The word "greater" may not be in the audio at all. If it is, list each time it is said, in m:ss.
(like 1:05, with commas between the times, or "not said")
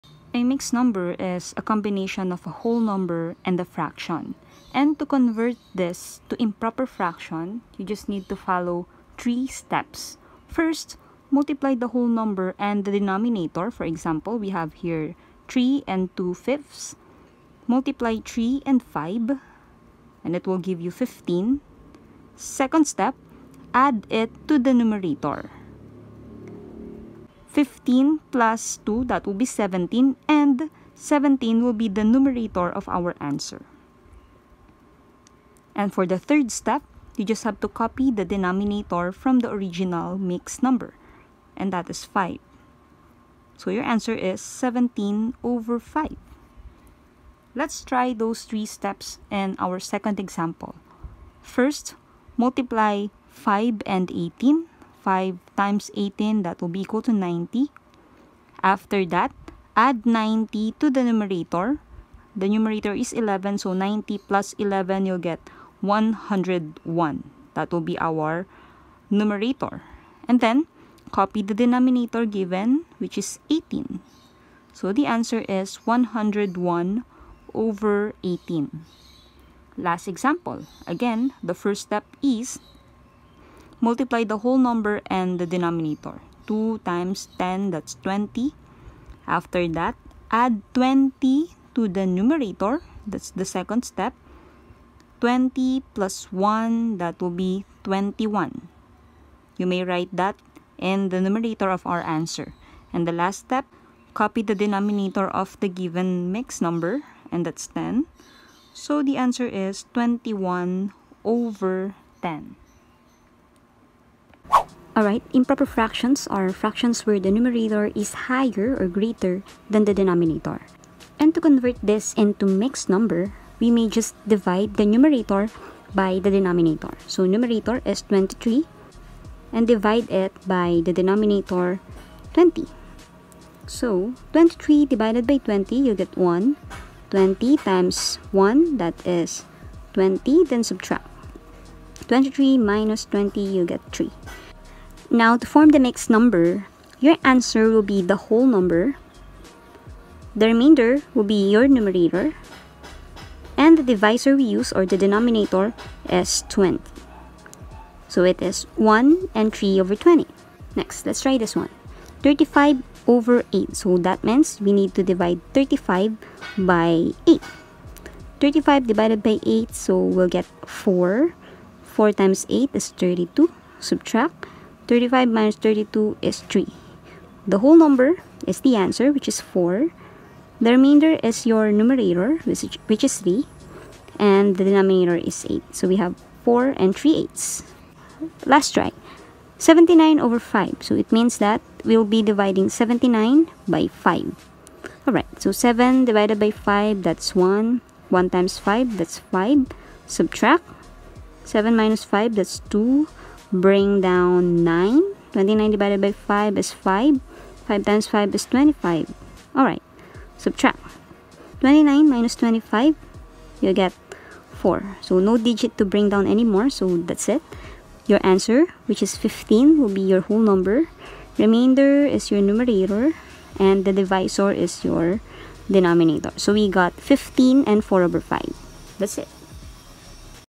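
1:58.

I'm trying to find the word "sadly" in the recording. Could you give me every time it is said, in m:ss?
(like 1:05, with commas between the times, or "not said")
not said.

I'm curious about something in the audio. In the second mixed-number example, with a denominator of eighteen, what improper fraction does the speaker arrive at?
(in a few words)
101/18.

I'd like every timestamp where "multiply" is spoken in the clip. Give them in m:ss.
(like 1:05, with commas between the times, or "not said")
0:11, 0:17, 0:52, 1:23.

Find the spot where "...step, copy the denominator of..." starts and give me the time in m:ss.
1:43.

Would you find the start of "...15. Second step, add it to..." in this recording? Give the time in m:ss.
0:20.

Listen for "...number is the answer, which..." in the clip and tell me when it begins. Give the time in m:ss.
2:57.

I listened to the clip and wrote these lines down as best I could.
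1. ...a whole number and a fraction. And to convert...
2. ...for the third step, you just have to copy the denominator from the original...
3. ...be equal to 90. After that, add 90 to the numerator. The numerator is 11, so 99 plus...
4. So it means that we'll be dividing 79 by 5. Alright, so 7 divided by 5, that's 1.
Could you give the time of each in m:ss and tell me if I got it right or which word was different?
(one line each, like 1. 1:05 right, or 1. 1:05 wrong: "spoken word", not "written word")
1. 0:02 right
2. 0:35 right
3. 0:56 wrong: "90", not "99"
4. 3:10 right.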